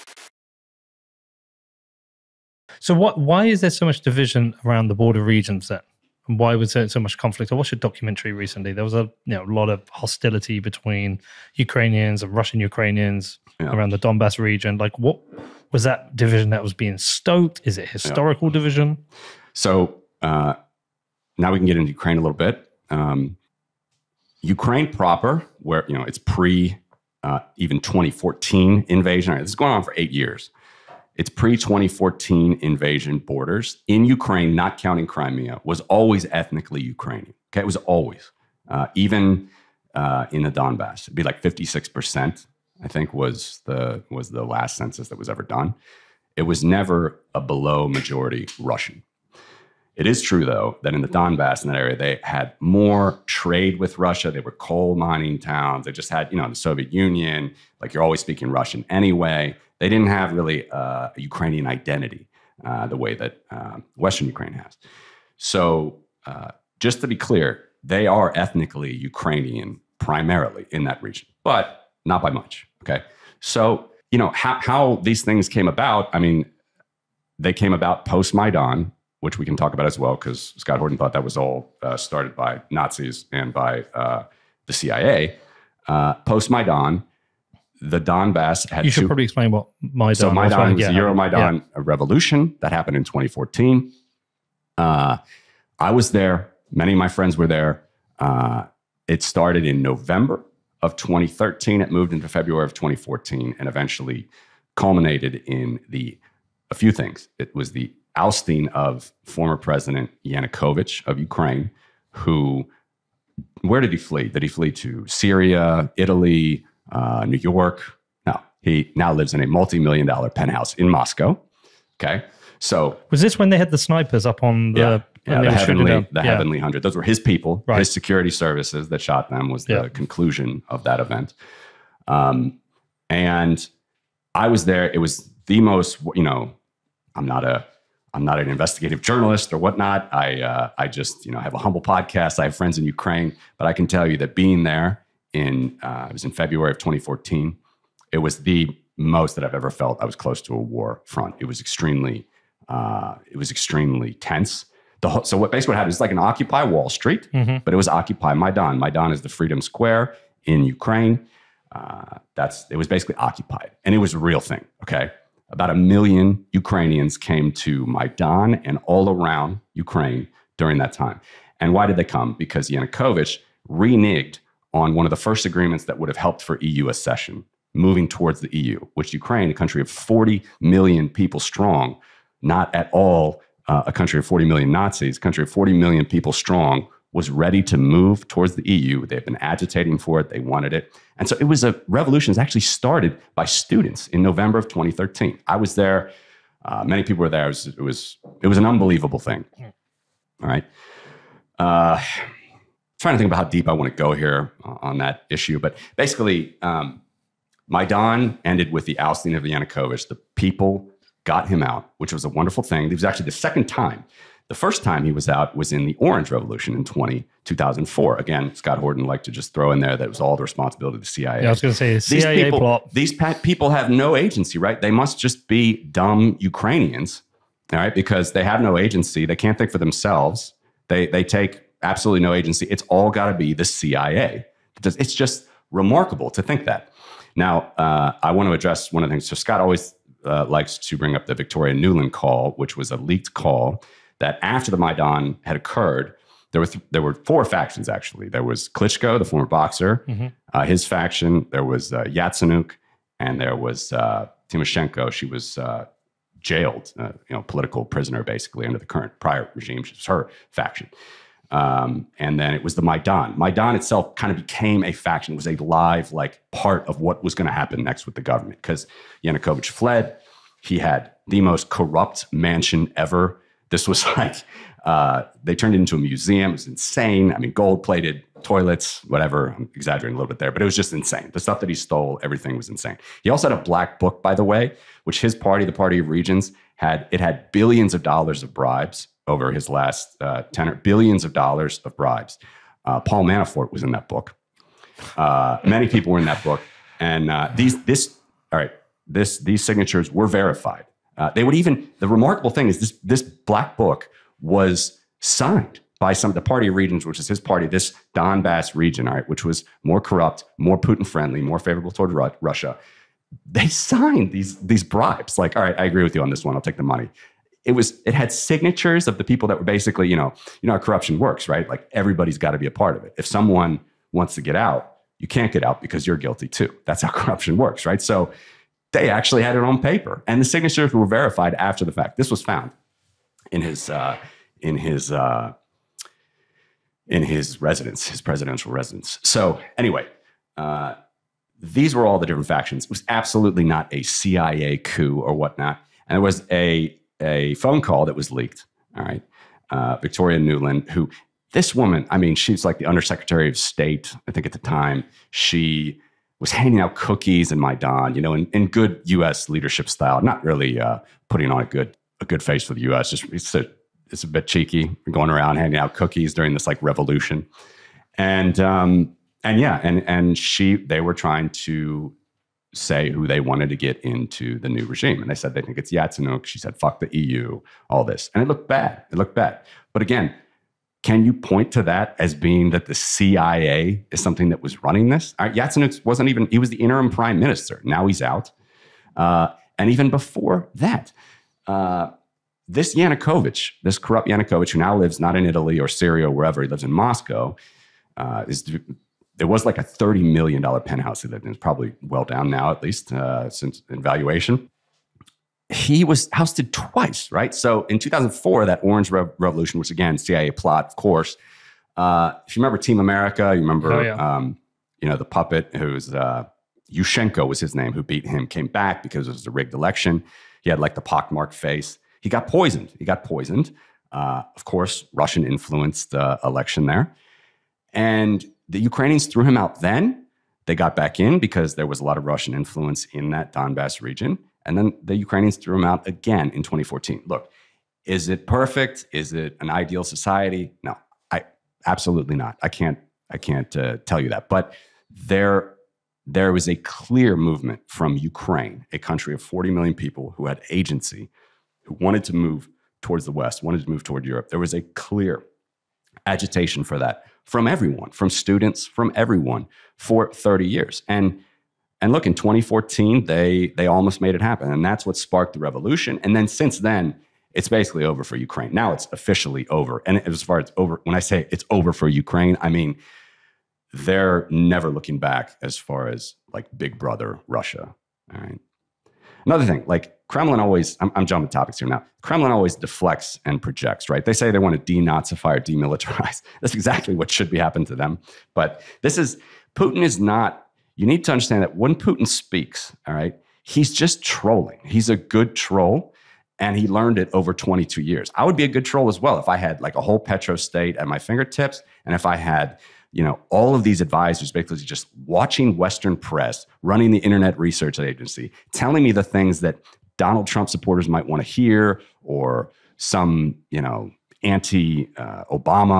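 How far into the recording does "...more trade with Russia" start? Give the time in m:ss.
0:52.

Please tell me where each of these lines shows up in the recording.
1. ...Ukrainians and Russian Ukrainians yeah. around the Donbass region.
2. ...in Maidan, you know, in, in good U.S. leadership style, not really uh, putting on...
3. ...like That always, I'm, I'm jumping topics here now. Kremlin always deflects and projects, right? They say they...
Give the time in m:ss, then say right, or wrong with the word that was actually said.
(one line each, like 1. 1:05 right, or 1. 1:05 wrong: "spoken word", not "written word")
1. 0:11 right
2. 5:57 right
3. 7:59 wrong: "Kremlin", not "That".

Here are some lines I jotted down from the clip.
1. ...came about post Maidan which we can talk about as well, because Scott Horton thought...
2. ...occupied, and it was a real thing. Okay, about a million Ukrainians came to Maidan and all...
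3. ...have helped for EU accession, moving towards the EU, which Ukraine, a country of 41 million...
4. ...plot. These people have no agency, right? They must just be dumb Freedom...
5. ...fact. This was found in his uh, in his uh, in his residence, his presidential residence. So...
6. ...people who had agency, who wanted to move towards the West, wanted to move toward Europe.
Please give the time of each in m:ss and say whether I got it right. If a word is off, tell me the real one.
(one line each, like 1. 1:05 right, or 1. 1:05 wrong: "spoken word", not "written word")
1. 1:17 right
2. 2:43 right
3. 2:56 wrong: "40", not "41"
4. 3:42 wrong: "Ukrainians", not "Freedom"
5. 5:31 right
6. 7:29 right.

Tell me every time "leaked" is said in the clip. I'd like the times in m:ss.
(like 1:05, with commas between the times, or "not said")
4:02, 5:48.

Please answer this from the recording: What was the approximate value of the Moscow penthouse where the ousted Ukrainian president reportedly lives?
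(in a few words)
$30 million.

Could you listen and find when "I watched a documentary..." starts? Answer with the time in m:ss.
0:07.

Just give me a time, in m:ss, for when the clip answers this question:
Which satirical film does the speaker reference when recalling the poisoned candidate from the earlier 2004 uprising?
6:52.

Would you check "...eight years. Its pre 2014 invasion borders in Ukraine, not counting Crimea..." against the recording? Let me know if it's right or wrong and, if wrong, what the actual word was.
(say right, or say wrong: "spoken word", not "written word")
right.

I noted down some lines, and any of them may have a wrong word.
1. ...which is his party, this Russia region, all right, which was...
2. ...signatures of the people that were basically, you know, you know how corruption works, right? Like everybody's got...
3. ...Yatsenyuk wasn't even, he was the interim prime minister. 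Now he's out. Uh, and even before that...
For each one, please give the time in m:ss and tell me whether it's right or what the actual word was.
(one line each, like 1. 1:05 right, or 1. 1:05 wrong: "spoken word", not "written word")
1. 5:07 wrong: "Donbass", not "Russia"
2. 5:18 right
3. 6:25 right.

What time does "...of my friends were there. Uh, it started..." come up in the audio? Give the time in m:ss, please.
1:36.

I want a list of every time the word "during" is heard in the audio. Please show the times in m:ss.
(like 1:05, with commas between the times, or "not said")
2:50, 6:06.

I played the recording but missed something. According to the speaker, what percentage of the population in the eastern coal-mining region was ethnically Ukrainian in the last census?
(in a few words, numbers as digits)
56%.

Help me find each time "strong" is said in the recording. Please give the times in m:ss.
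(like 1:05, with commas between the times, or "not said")
3:01, 3:06.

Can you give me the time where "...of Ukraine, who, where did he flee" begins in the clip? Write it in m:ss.
1:51.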